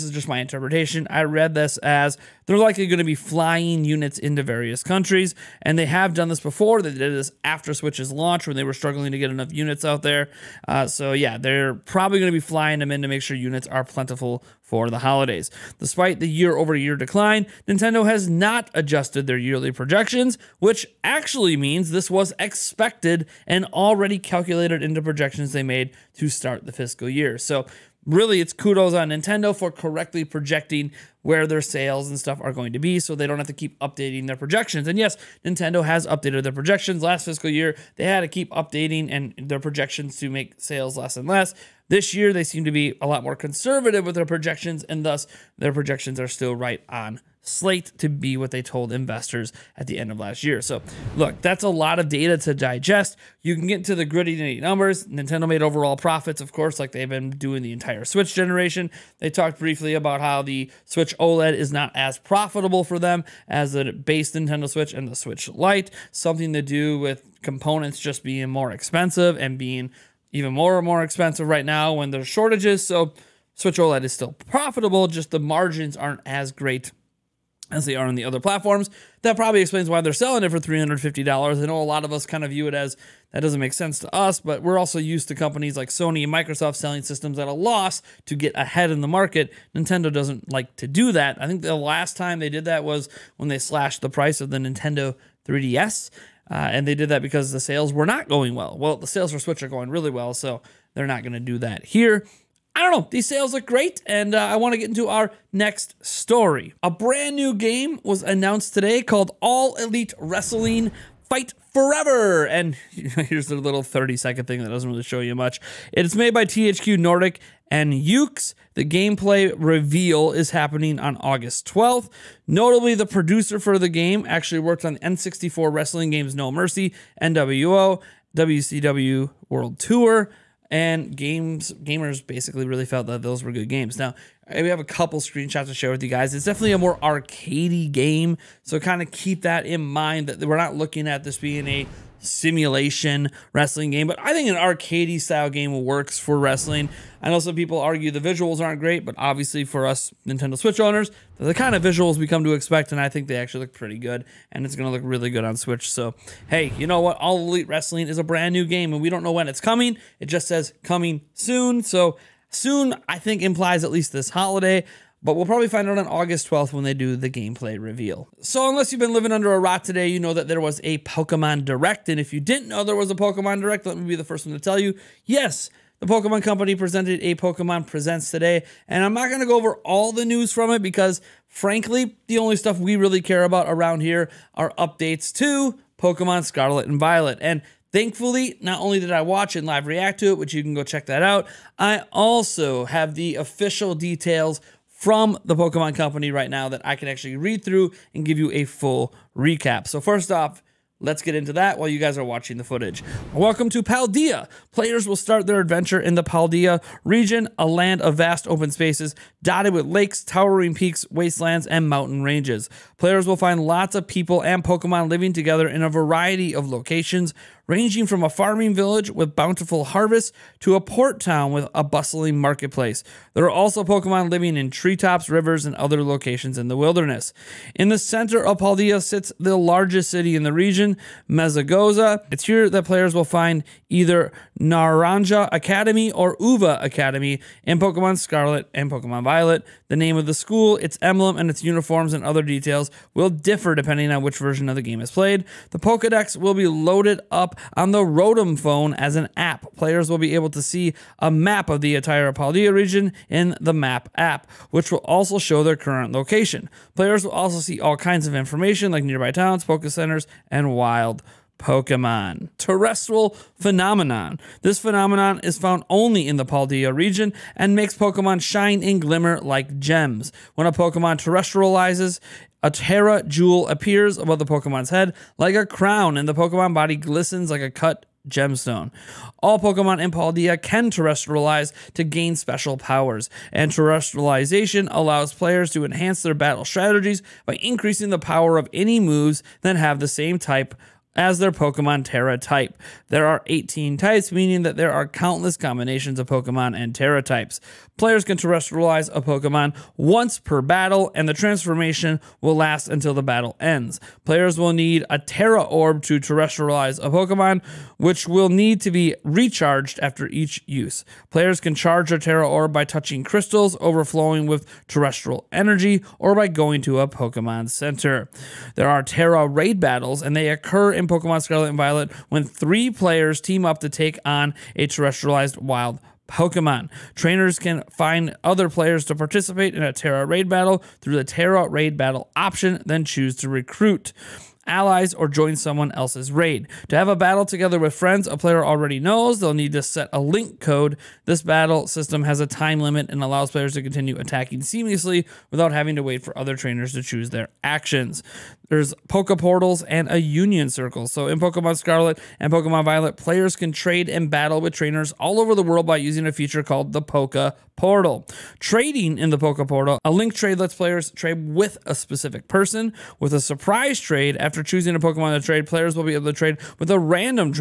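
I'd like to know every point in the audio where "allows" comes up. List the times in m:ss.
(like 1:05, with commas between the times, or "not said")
4:44, 5:43.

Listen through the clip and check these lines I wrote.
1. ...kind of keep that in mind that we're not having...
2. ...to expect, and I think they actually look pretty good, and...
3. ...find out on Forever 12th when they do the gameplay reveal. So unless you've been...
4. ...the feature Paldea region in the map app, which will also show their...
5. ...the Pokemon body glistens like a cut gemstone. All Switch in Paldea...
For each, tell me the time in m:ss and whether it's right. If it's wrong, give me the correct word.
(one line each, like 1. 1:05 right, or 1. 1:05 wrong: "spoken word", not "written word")
1. 2:18 wrong: "looking", not "having"
2. 2:32 right
3. 2:45 wrong: "August", not "Forever"
4. 4:11 wrong: "entire", not "feature"
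5. 4:36 wrong: "Pokemon", not "Switch".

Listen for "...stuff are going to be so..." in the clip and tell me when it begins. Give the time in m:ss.
0:32.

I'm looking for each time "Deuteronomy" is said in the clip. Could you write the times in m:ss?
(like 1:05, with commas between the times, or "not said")
not said.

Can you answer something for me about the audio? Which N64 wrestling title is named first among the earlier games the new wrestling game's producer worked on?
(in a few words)
No Mercy.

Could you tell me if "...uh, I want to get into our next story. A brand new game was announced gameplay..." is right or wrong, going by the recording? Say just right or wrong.
wrong.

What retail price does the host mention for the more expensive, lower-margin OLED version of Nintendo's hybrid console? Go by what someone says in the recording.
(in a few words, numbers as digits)
$350.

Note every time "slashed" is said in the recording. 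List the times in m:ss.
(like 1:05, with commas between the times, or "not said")
1:33.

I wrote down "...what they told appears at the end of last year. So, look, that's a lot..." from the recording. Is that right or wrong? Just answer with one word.
wrong.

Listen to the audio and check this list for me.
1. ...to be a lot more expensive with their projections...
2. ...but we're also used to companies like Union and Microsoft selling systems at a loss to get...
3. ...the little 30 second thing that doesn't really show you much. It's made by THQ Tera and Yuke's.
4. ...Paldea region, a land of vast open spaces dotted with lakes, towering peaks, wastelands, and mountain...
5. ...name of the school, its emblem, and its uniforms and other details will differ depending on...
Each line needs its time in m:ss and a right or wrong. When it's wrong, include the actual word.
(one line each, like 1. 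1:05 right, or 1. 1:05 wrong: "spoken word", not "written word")
1. 0:42 wrong: "conservative", not "expensive"
2. 1:24 wrong: "Sony", not "Union"
3. 1:53 wrong: "Nordic", not "Tera"
4. 3:26 right
5. 3:59 right.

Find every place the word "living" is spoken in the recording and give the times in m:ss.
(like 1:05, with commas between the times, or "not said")
2:49, 3:35, 3:44.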